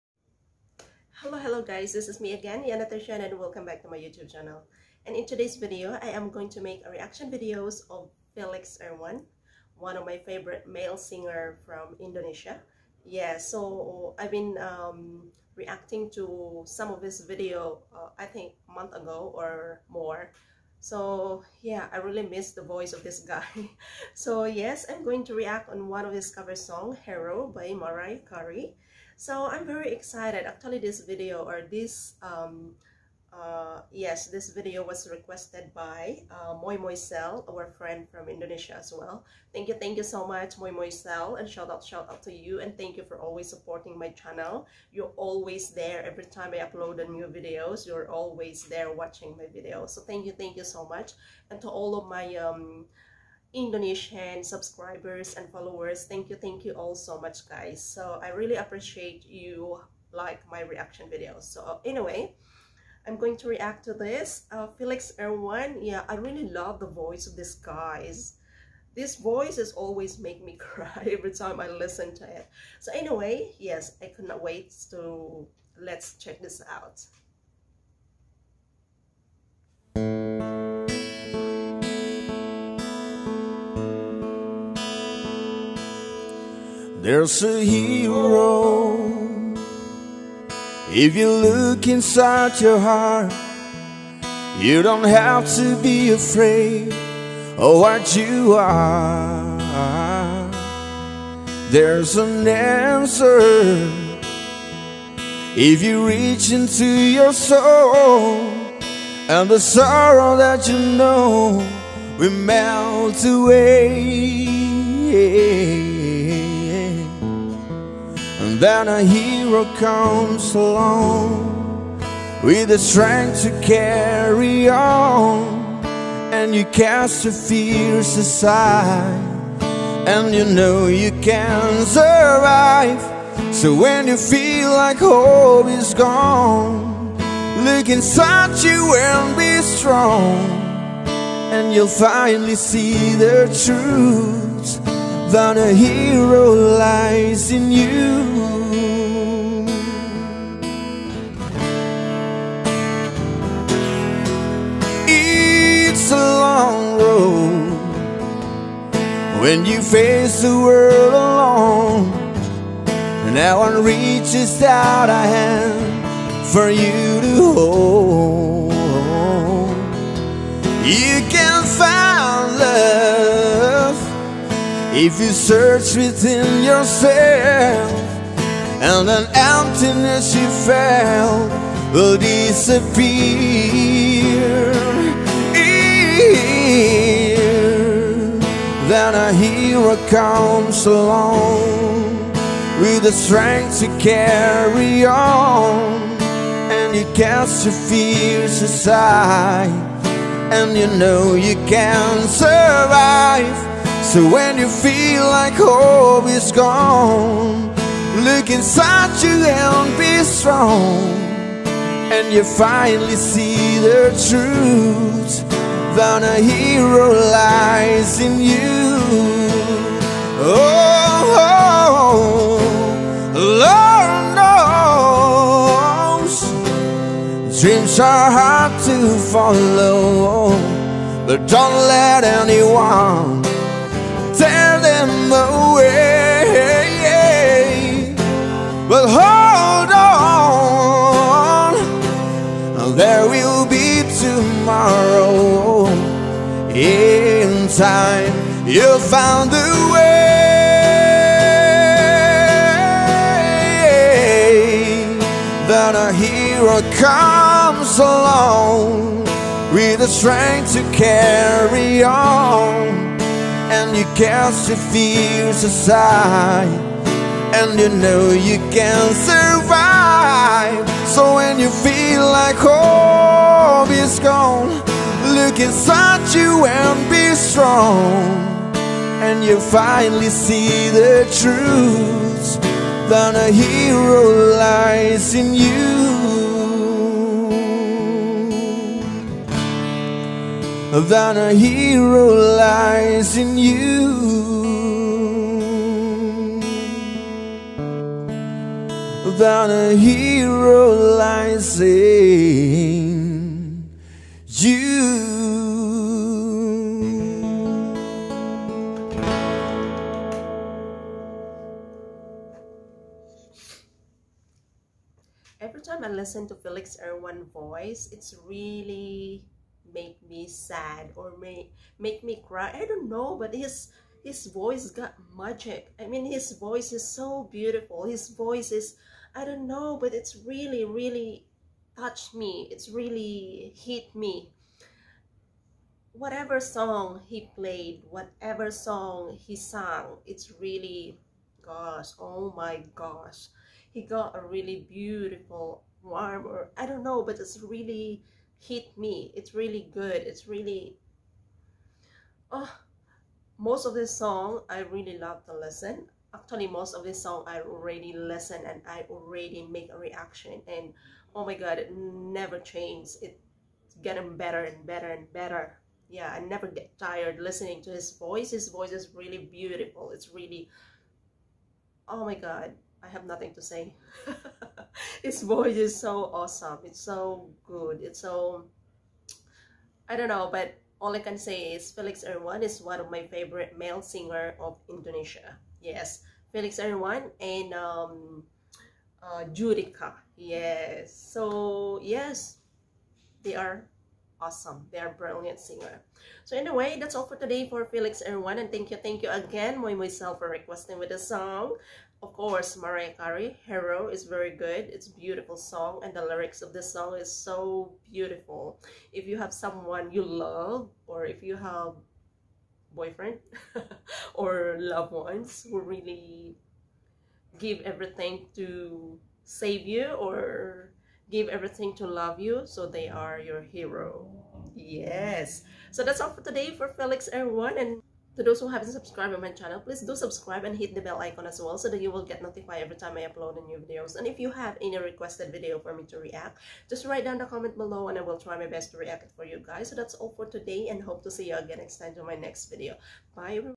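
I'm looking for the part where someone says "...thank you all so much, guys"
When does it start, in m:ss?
0:56.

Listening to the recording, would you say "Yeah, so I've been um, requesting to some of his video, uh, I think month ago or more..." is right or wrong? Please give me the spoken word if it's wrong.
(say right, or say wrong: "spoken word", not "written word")
wrong: "reacting", not "requesting".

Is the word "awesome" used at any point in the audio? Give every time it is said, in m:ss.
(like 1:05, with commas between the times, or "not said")
6:16, 6:34.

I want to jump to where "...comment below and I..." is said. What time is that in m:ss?
7:17.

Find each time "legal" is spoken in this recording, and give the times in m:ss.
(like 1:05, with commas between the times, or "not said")
not said.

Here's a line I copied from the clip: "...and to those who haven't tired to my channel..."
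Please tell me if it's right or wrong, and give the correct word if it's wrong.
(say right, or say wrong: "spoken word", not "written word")
wrong: "subscribed", not "tired".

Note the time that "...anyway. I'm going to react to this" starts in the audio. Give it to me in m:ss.
1:01.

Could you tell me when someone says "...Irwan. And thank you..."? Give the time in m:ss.
6:38.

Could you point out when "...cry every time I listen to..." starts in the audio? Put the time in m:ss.
1:10.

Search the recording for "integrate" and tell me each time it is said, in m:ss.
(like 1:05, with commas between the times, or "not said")
not said.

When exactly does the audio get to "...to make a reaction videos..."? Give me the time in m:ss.
0:06.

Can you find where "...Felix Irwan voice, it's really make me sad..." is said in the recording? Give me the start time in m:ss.
5:16.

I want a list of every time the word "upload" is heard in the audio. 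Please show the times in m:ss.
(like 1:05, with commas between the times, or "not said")
0:46, 7:13.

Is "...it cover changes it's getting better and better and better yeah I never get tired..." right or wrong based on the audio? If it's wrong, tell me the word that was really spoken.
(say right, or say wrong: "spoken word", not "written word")
wrong: "never", not "cover".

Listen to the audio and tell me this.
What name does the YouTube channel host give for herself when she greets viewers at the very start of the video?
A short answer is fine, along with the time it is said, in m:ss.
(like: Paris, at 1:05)
Yanna Tarzhanna, at 0:02.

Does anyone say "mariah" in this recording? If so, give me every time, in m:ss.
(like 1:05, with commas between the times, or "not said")
0:27, 6:42.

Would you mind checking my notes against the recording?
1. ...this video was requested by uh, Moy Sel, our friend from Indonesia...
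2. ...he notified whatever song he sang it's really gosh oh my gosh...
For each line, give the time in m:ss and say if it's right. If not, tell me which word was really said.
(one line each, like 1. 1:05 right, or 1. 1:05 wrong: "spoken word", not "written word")
1. 0:34 right
2. 5:37 wrong: "played", not "notified".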